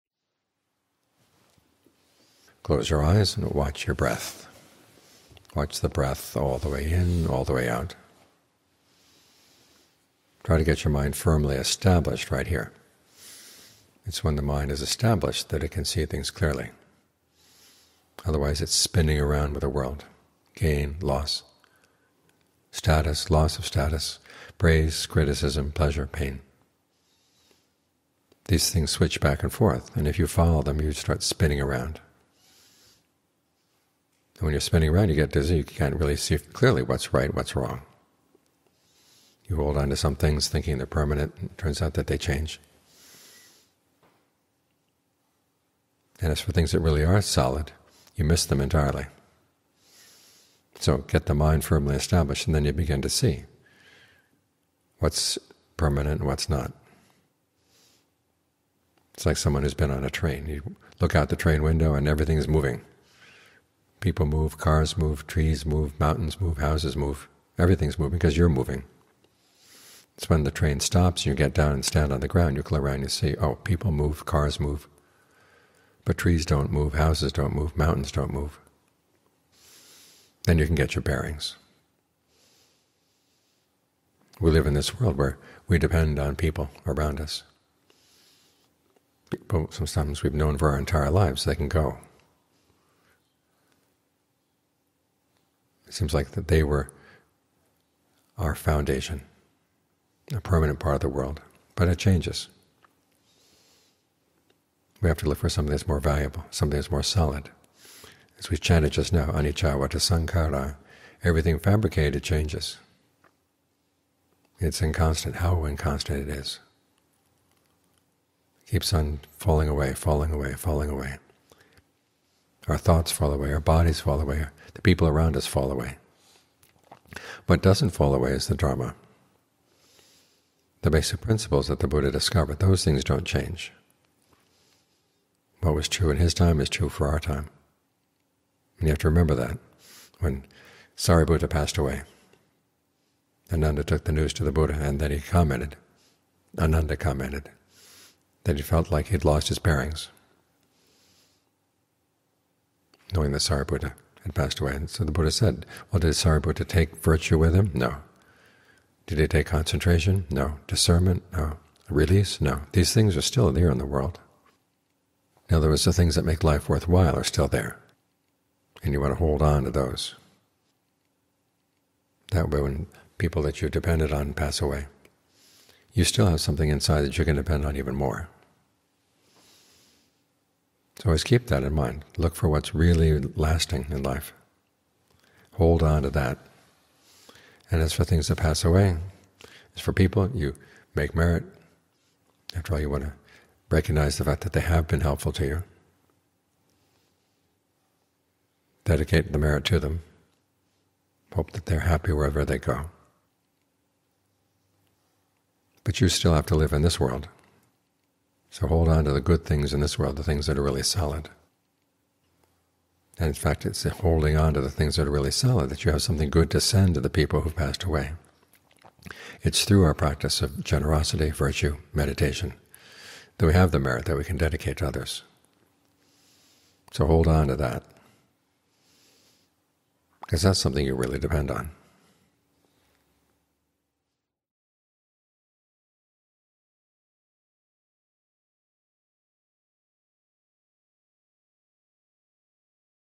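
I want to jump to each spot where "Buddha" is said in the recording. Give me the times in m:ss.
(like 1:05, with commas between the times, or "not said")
2:11, 2:24, 2:35.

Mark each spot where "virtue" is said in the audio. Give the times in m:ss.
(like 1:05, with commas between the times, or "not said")
2:36, 3:41.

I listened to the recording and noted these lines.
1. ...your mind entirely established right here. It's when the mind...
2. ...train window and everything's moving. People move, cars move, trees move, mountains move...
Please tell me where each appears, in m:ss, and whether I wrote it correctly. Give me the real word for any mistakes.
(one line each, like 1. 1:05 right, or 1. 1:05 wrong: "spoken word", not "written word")
1. 0:10 wrong: "firmly", not "entirely"
2. 1:01 right.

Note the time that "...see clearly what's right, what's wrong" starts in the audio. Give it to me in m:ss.
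0:36.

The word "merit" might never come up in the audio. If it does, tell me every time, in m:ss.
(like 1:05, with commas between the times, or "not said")
3:11, 3:19, 3:43.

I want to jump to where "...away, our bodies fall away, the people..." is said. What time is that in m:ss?
2:03.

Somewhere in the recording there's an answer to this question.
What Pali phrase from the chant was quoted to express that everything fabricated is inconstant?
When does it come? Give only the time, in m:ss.
1:49.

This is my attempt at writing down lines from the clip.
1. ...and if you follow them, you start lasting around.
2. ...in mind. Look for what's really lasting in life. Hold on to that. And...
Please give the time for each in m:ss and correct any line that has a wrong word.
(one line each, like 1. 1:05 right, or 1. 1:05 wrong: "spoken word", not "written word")
1. 0:29 wrong: "spinning", not "lasting"
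2. 3:01 right.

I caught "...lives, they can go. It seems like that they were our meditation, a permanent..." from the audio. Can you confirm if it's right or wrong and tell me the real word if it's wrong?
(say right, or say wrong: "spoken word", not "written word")
wrong: "foundation", not "meditation".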